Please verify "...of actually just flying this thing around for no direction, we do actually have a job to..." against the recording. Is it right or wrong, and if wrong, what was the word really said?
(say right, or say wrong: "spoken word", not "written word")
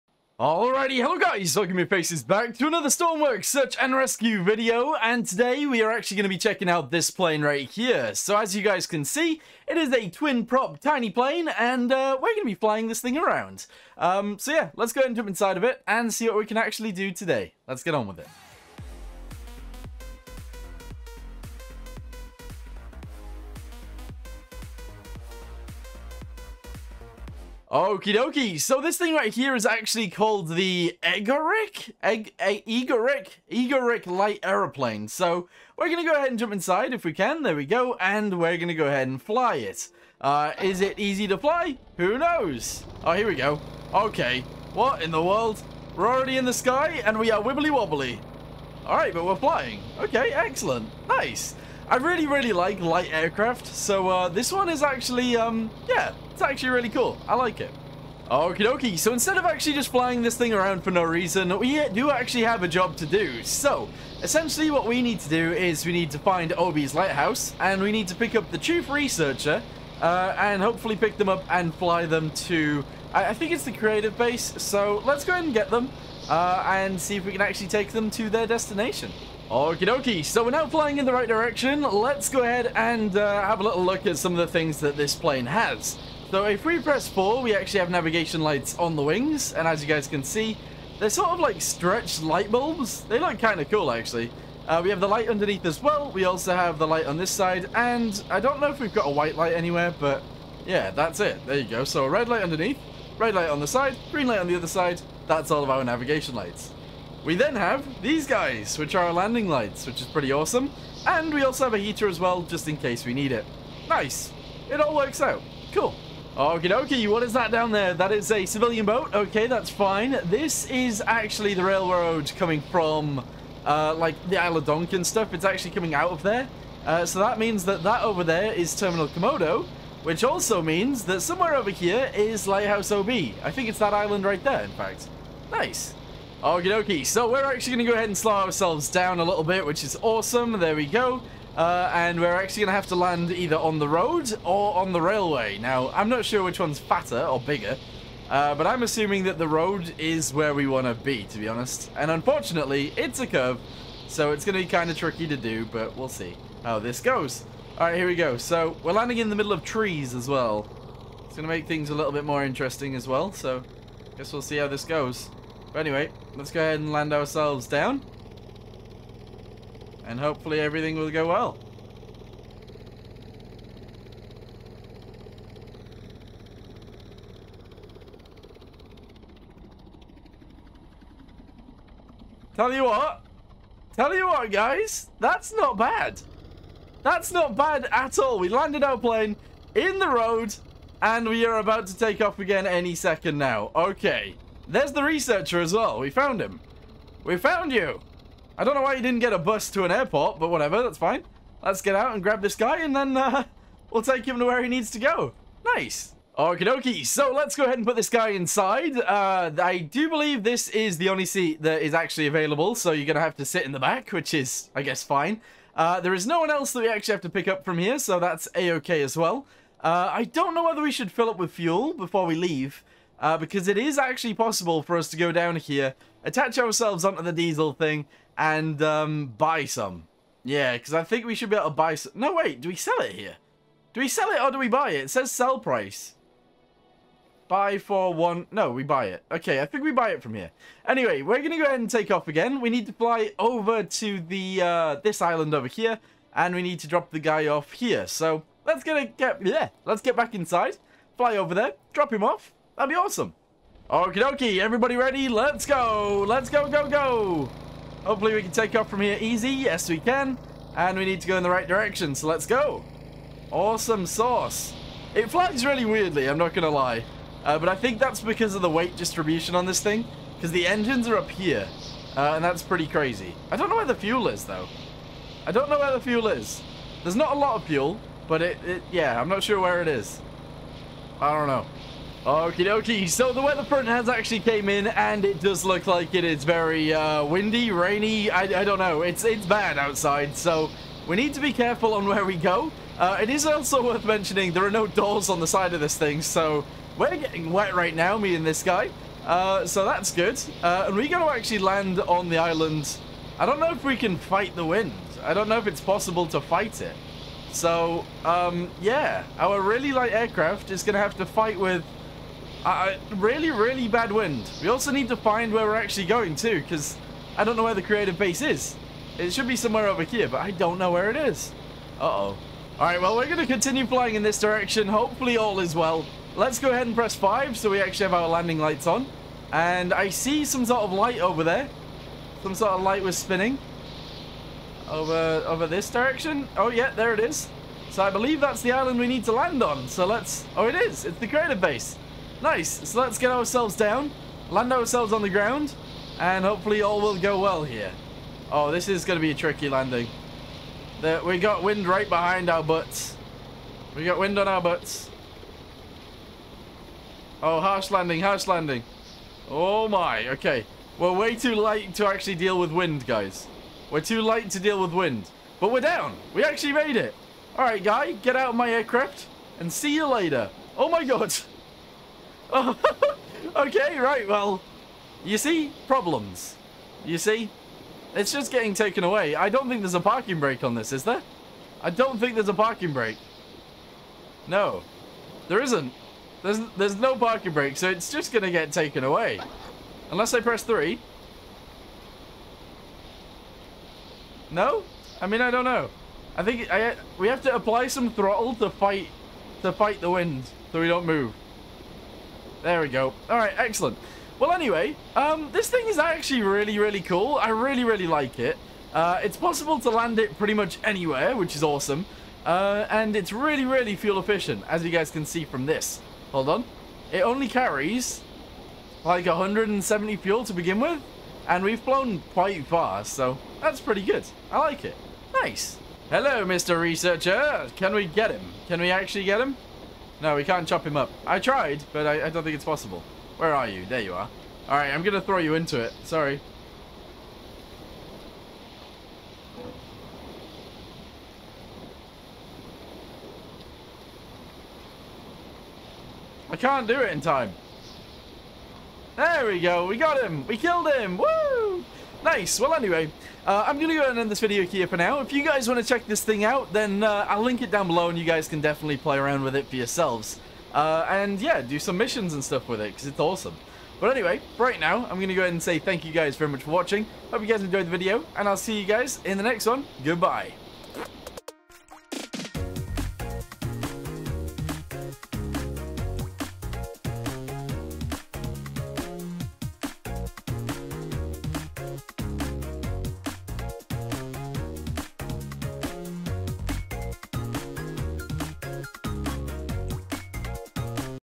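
wrong: "reason", not "direction".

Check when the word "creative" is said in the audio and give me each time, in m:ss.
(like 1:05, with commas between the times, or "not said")
1:13, 5:17, 5:41.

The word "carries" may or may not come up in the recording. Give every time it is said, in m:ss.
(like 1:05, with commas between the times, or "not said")
6:57.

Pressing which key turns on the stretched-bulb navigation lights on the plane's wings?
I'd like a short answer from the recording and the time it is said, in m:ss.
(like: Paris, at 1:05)
4, at 1:27.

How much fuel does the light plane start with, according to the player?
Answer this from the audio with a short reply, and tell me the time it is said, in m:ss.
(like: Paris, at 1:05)
170, at 6:59.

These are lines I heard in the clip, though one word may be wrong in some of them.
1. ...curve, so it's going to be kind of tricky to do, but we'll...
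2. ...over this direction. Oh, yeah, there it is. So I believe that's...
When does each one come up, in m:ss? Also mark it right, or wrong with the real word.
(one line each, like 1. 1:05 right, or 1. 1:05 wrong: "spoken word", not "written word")
1. 2:33 right
2. 5:35 right.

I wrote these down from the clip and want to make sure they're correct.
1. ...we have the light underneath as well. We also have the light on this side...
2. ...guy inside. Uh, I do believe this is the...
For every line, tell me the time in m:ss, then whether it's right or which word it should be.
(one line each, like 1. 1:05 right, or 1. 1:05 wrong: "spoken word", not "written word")
1. 1:34 right
2. 3:28 right.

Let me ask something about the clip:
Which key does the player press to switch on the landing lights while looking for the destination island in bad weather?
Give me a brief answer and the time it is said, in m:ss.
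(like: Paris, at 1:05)
5, at 5:27.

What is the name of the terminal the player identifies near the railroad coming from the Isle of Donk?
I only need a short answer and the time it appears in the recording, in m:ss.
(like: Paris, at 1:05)
Terminal Camodo, at 2:08.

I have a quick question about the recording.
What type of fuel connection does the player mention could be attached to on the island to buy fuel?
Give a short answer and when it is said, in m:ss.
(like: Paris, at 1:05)
diesel, at 3:47.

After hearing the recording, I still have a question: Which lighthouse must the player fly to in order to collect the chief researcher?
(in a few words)
Lighthouse OB.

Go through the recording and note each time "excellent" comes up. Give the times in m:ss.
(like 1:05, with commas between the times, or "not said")
0:50, 6:43.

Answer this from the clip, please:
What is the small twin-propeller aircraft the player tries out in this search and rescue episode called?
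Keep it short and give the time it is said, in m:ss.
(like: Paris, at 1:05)
Egorych light aeroplane, at 0:33.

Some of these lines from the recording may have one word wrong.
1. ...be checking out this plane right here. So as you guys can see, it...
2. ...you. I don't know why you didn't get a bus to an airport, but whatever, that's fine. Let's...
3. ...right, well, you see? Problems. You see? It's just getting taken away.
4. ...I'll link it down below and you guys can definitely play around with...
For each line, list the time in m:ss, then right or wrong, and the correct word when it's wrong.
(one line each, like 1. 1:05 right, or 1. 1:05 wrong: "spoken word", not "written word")
1. 0:06 right
2. 3:17 right
3. 6:13 right
4. 7:37 right.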